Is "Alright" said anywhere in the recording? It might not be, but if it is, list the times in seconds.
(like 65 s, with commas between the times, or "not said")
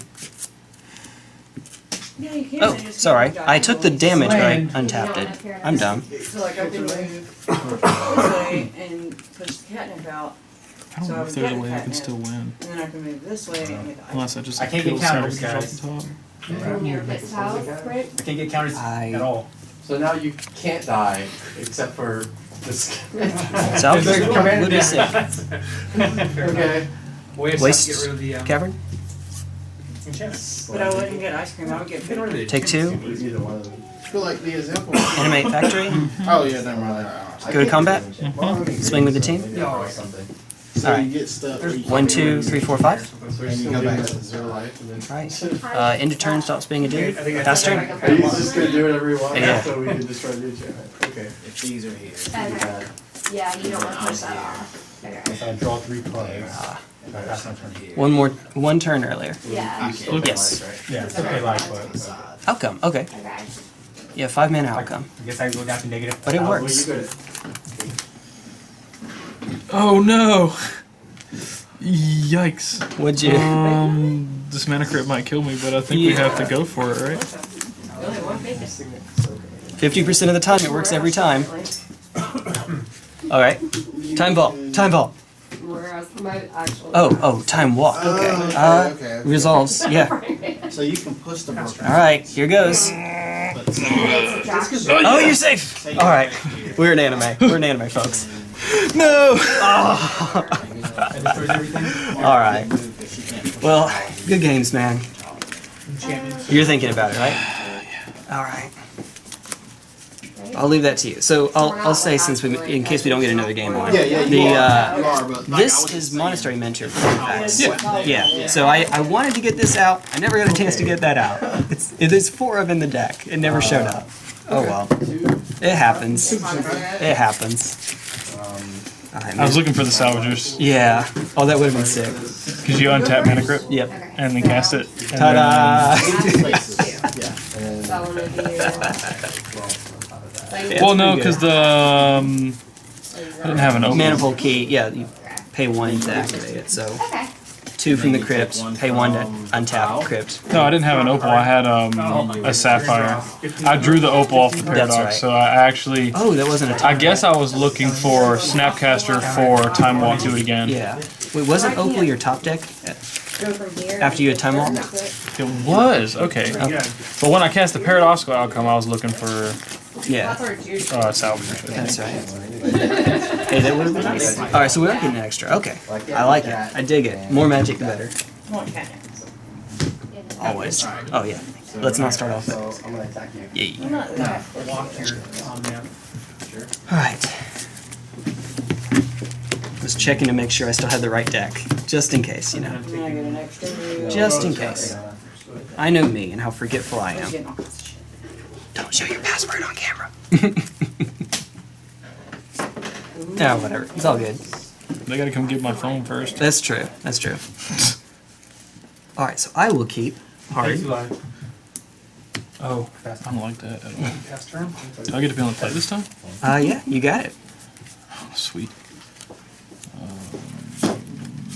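83 s, 91 s, 95 s.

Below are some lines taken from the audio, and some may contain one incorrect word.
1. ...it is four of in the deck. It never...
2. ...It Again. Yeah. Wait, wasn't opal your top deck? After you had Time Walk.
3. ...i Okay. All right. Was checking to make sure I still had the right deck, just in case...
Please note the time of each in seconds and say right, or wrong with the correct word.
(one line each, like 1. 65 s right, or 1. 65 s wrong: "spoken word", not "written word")
1. 122 s right
2. 160 s right
3. 182 s wrong: "Yeah", not "Okay".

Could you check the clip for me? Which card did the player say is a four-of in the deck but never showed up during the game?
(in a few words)
Monastery Mentor.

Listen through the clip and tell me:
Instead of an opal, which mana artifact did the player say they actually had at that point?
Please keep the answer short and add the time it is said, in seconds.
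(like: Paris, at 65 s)
Sapphire, at 152 s.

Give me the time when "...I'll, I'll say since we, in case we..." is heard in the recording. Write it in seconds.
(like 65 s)
111 s.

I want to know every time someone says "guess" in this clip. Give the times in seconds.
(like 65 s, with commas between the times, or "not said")
65 s, 156 s.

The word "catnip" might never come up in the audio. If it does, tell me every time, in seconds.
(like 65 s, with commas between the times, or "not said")
9 s.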